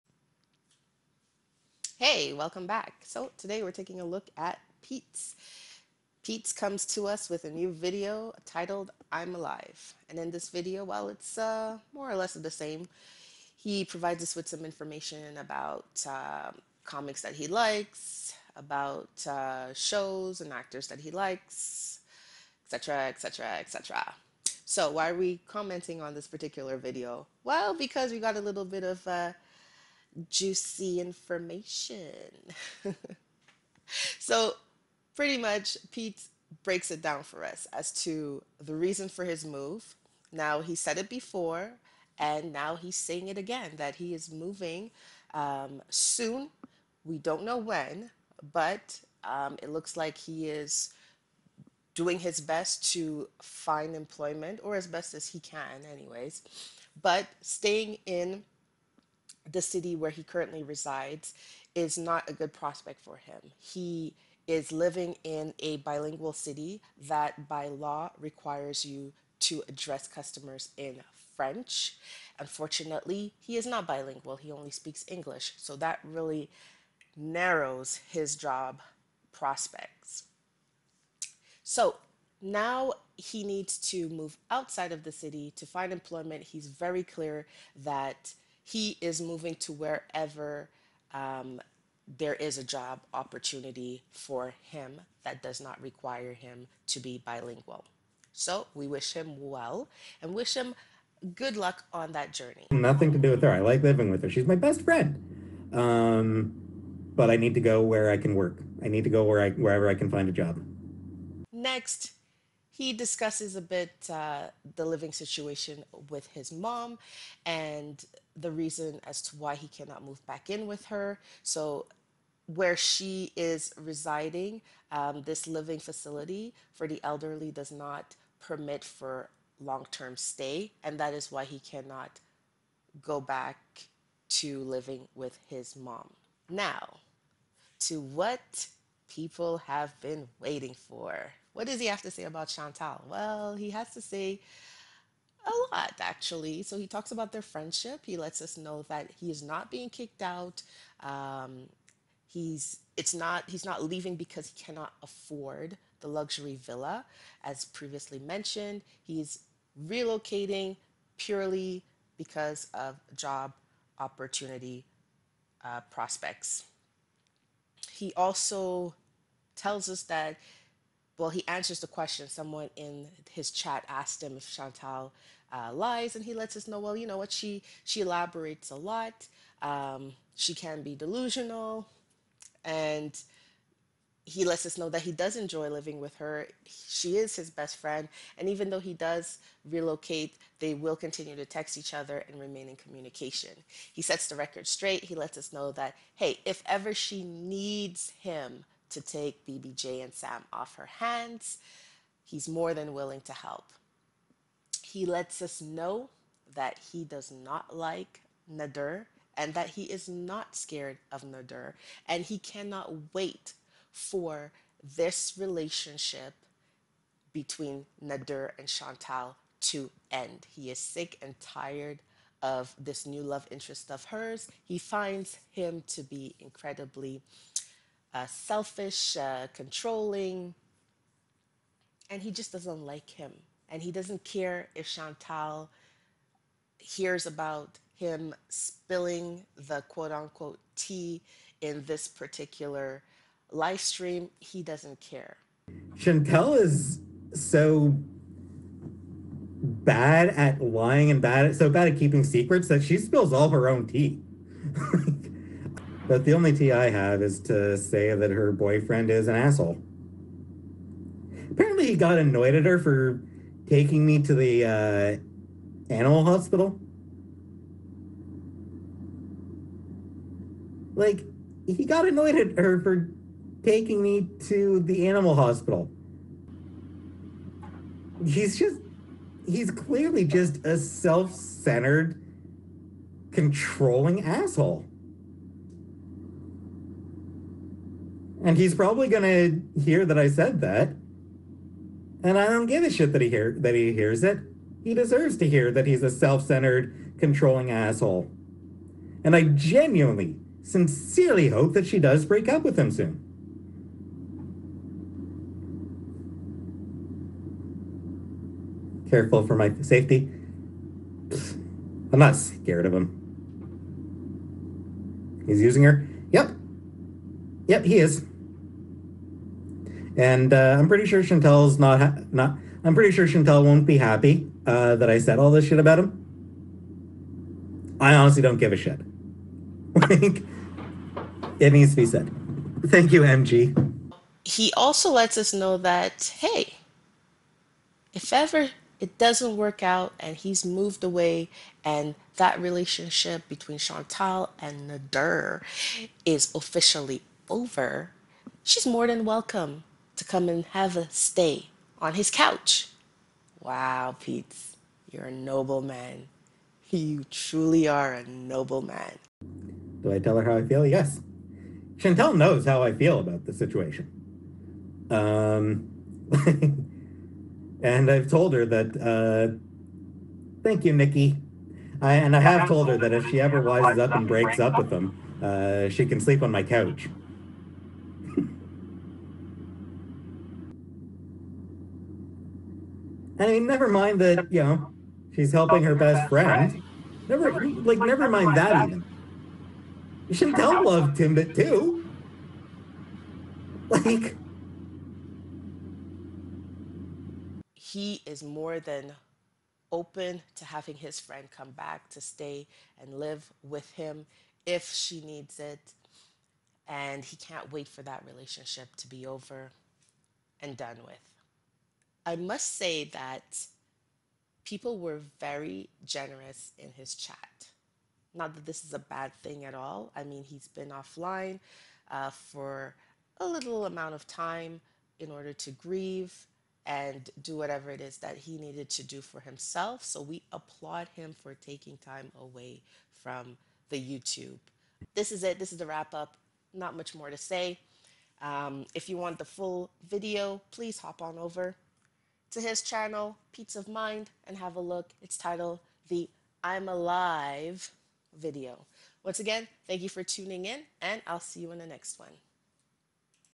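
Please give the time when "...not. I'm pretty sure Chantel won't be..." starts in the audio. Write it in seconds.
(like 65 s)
322 s.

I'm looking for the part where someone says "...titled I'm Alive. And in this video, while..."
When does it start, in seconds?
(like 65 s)
8 s.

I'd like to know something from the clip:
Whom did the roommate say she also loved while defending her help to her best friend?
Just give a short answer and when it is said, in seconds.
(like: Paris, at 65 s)
Timbit, at 391 s.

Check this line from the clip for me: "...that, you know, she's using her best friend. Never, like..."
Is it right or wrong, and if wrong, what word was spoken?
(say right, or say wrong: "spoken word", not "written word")
wrong: "helping", not "using".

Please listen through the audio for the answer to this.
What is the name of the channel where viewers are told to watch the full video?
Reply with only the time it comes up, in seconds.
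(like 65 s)
443 s.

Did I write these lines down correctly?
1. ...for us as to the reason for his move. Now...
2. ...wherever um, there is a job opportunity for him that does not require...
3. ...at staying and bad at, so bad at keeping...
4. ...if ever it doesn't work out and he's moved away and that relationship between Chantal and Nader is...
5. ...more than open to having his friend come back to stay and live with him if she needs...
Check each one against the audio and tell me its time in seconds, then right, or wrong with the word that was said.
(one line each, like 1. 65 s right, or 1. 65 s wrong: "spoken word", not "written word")
1. 37 s right
2. 89 s right
3. 250 s wrong: "lying", not "staying"
4. 338 s right
5. 398 s right.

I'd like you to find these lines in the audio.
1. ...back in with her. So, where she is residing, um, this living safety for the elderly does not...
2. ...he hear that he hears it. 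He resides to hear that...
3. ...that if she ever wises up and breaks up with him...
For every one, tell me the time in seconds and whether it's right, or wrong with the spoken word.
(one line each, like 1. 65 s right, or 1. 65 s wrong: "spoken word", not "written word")
1. 120 s wrong: "facility", not "safety"
2. 293 s wrong: "deserves", not "resides"
3. 372 s right.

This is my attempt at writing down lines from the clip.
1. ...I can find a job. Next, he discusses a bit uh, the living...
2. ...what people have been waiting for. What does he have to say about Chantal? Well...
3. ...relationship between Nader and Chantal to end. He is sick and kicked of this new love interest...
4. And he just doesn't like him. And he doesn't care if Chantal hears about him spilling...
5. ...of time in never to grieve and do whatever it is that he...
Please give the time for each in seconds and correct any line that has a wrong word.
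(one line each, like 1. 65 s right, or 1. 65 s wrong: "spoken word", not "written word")
1. 109 s right
2. 138 s right
3. 215 s wrong: "tired", not "kicked"
4. 232 s right
5. 424 s wrong: "order", not "never".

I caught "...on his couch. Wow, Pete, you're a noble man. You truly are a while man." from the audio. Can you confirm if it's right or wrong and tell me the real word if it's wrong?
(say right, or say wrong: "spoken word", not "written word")
wrong: "noble", not "while".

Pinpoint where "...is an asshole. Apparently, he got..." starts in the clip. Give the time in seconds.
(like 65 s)
259 s.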